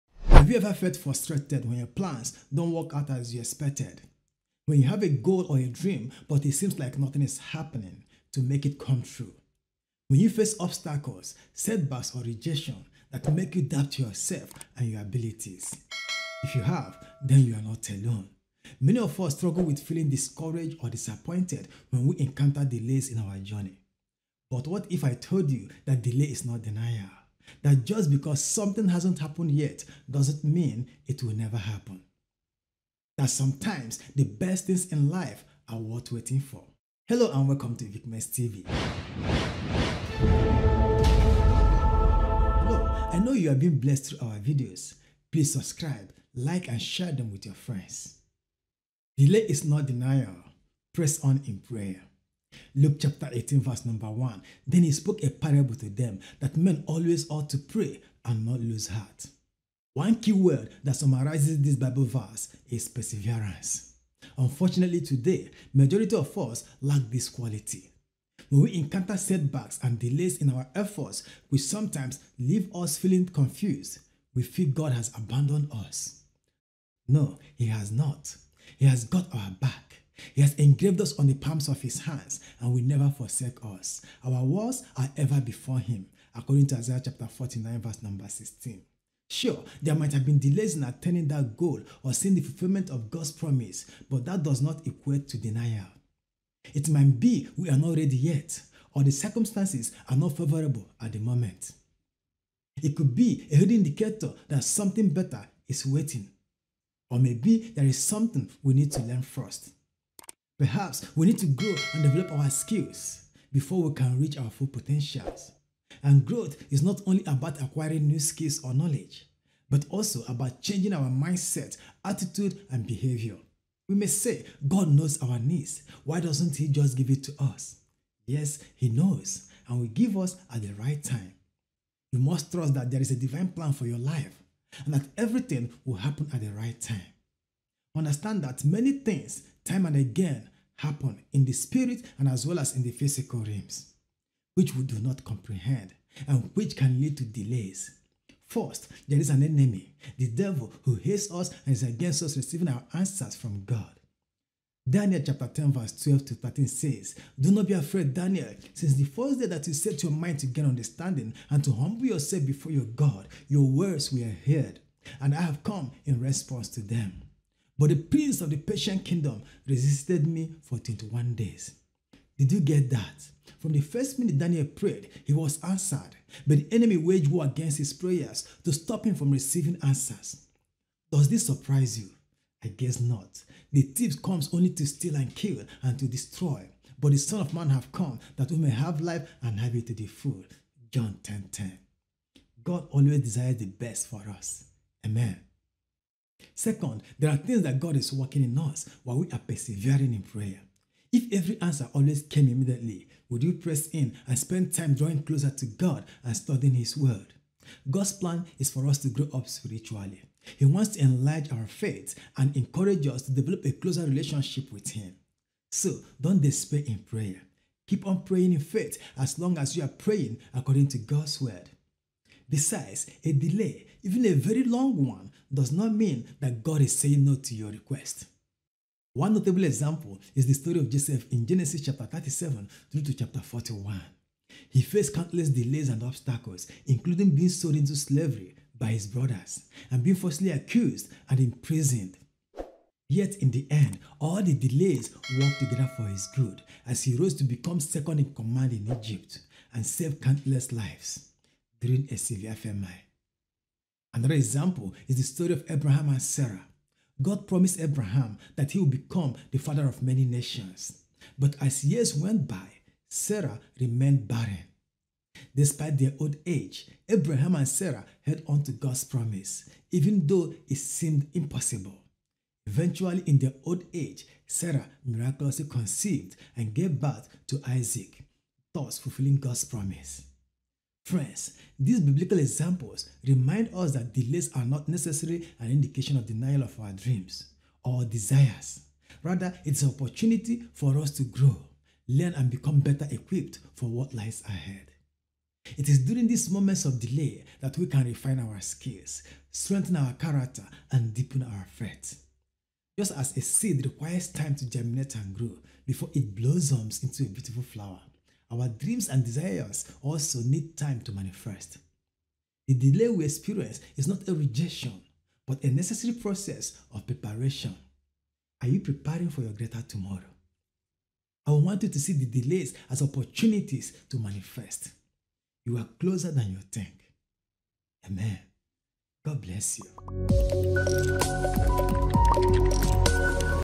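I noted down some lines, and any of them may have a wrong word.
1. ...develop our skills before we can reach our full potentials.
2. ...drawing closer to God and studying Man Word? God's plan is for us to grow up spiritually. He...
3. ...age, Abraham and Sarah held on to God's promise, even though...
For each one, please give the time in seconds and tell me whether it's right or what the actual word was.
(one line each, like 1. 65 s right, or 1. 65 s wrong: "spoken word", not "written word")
1. 112 s right
2. 204 s wrong: "His", not "Man"
3. 266 s right.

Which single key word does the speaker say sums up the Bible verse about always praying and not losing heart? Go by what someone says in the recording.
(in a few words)
Perseverance.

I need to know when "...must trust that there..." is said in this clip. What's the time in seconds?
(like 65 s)
132 s.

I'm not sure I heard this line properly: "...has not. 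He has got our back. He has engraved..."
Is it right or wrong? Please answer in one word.
right.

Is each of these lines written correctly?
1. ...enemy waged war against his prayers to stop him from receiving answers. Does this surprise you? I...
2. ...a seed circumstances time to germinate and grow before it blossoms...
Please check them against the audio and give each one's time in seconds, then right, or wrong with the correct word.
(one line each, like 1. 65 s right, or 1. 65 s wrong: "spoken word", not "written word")
1. 176 s right
2. 303 s wrong: "requires", not "circumstances".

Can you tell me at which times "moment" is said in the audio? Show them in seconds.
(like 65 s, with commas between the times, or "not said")
101 s, 296 s.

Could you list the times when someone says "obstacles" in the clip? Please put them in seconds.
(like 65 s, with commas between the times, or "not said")
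10 s, 236 s.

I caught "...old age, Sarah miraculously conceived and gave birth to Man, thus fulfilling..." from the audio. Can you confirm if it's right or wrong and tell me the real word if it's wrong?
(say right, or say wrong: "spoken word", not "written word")
wrong: "Isaac", not "Man".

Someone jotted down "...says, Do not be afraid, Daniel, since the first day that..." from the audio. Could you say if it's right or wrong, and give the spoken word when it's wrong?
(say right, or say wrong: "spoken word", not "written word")
right.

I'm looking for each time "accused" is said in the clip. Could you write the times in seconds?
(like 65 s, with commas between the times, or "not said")
240 s.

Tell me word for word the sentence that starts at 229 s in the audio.
One notable example is the story of Joseph in Genesis chapter 37 through to chapter 41.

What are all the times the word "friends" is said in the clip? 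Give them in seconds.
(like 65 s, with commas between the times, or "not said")
47 s, 281 s.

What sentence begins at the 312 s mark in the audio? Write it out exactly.
The delay we experience is not a rejection, but a necessary process of preparation.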